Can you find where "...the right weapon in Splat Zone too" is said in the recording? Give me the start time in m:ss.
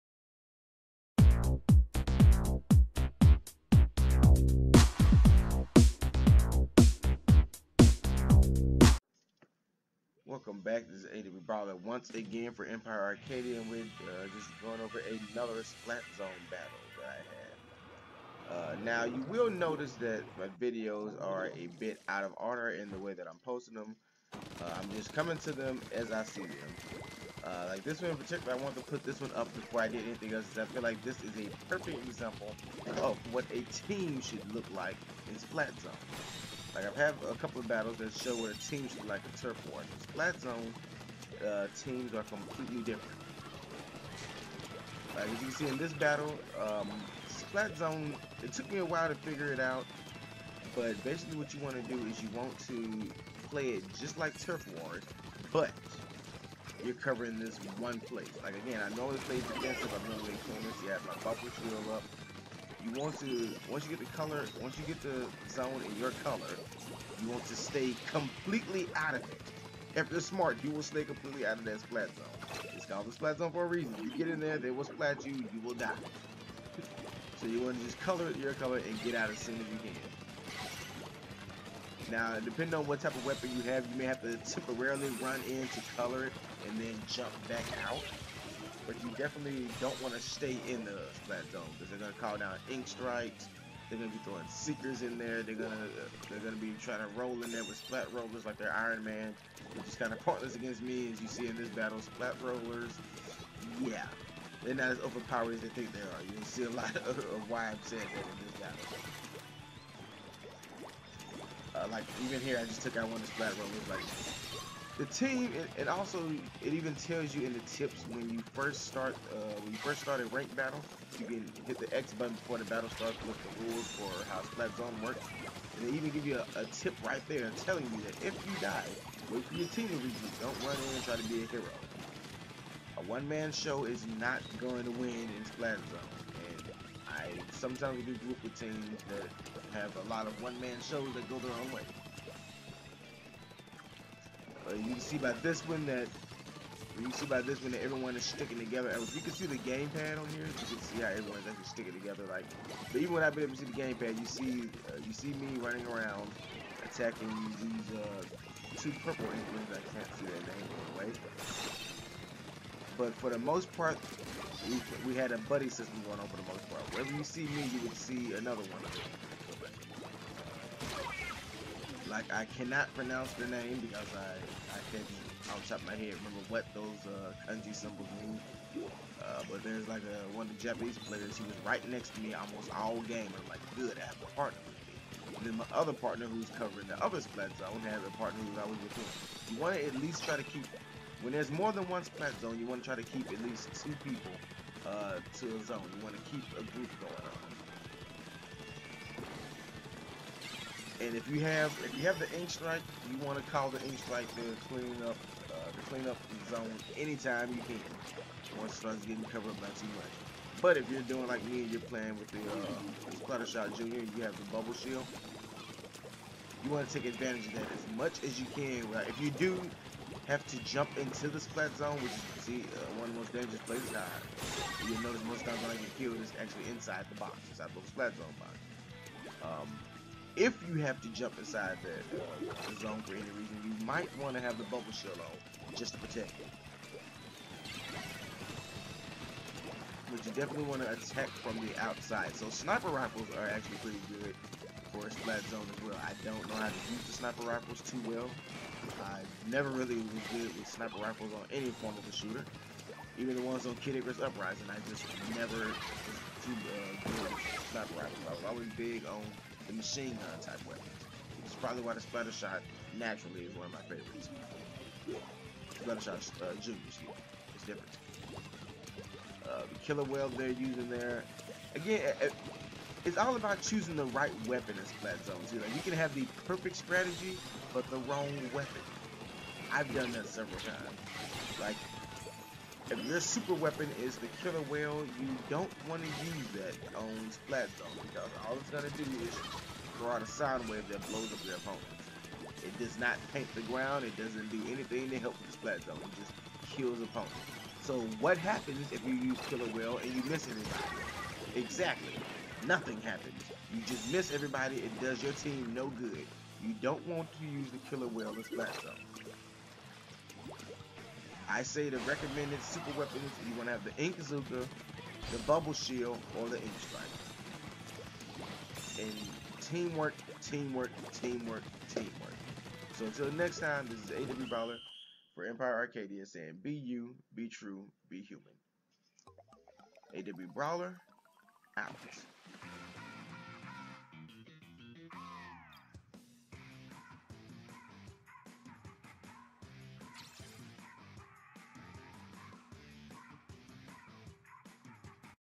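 4:33.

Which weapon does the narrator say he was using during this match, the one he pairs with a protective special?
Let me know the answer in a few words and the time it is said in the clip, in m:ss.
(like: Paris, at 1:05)
Splatter Shot Junior, at 3:33.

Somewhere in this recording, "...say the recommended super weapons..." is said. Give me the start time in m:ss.
5:11.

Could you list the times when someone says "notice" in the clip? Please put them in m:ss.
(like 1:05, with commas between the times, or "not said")
0:19, 3:45.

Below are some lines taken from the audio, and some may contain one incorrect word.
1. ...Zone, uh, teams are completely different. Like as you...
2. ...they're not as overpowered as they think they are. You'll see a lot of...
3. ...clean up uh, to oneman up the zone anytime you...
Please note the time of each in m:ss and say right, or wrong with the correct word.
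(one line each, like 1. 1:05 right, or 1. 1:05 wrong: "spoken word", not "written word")
1. 0:40 right
2. 1:44 right
3. 3:24 wrong: "clean", not "oneman".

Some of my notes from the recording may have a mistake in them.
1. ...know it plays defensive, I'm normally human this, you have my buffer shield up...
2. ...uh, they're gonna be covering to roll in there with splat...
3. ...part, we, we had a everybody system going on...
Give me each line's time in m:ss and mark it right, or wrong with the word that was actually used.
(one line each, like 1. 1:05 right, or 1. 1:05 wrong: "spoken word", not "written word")
1. 0:58 wrong: "clean", not "human"
2. 1:35 wrong: "trying", not "covering"
3. 2:43 wrong: "buddy", not "everybody".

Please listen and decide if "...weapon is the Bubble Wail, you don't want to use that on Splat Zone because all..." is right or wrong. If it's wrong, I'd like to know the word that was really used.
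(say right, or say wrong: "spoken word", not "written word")
wrong: "Killer", not "Bubble".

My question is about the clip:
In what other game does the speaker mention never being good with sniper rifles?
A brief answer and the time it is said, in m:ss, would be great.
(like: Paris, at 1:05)
Kid Icarus Uprising, at 4:13.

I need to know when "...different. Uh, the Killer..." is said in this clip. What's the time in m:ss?
4:27.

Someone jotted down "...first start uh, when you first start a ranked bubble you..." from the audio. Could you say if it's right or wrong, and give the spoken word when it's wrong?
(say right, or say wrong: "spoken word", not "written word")
wrong: "battle", not "bubble".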